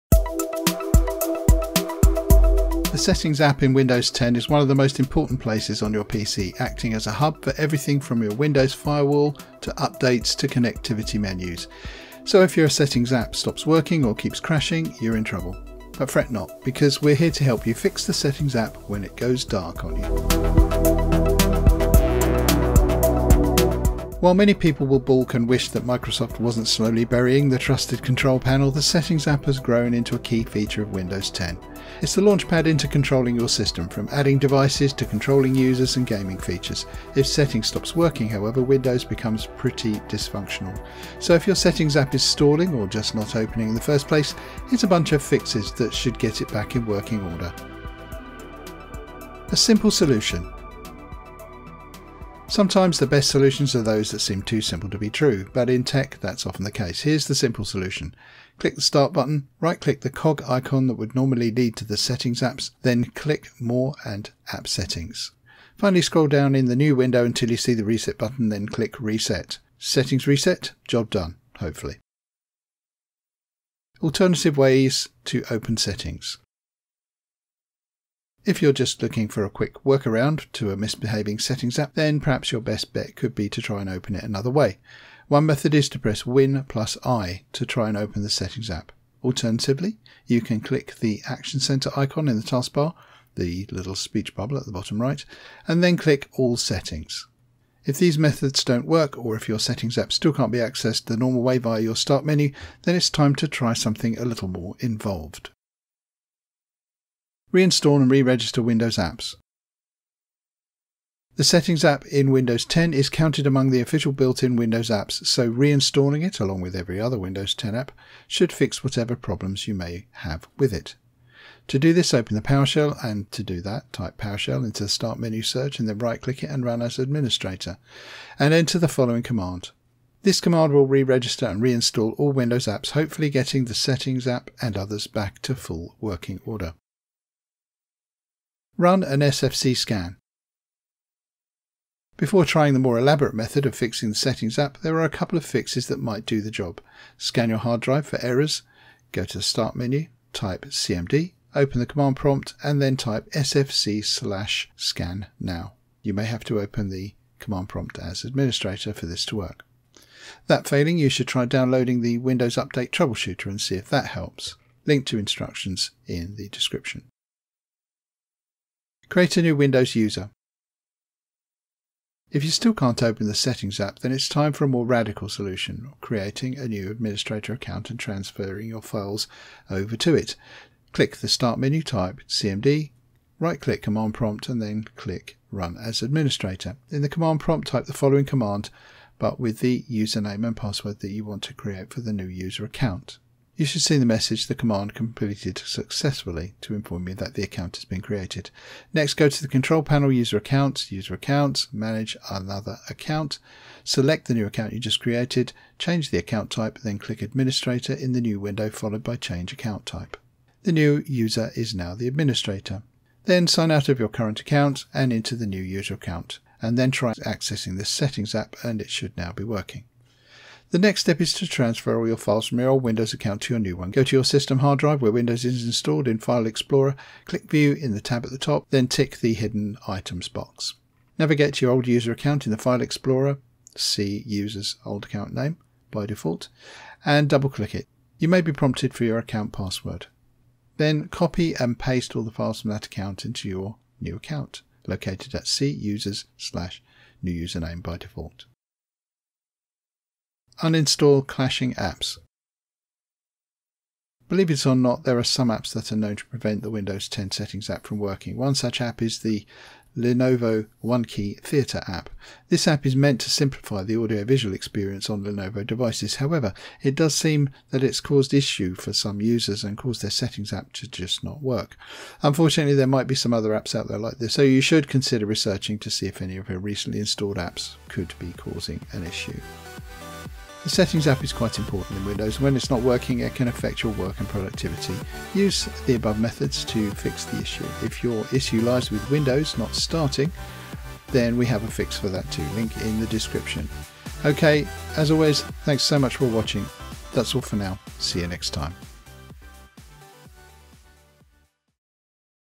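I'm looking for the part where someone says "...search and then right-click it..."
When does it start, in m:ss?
2:05.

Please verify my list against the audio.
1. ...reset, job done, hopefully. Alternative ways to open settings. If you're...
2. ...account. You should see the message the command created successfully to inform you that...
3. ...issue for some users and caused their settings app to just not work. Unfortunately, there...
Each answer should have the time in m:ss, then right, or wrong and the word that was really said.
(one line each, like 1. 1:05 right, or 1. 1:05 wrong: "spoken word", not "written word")
1. 1:10 right
2. 3:12 wrong: "completed", not "created"
3. 4:28 right.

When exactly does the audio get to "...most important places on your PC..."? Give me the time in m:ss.
0:04.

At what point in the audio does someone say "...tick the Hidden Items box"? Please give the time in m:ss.
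3:48.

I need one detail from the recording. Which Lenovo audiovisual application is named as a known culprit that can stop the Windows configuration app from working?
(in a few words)
Lenovo OneKey Theatre.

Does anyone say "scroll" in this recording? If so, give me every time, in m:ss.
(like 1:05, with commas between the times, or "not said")
1:06.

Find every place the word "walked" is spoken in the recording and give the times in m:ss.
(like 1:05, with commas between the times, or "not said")
not said.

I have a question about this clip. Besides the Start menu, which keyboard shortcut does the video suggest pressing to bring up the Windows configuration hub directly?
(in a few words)
Win plus I.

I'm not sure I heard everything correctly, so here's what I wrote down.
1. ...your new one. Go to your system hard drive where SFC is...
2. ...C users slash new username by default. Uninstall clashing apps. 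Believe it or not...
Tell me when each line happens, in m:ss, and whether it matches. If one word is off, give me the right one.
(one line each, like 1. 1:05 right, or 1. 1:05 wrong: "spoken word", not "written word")
1. 3:43 wrong: "Windows", not "SFC"
2. 4:05 right.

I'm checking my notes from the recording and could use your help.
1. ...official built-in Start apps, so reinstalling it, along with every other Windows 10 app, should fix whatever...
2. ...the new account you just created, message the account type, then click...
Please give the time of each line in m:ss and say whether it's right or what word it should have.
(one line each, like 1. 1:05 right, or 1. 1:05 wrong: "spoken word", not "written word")
1. 1:53 wrong: "Windows", not "Start"
2. 3:24 wrong: "change", not "message".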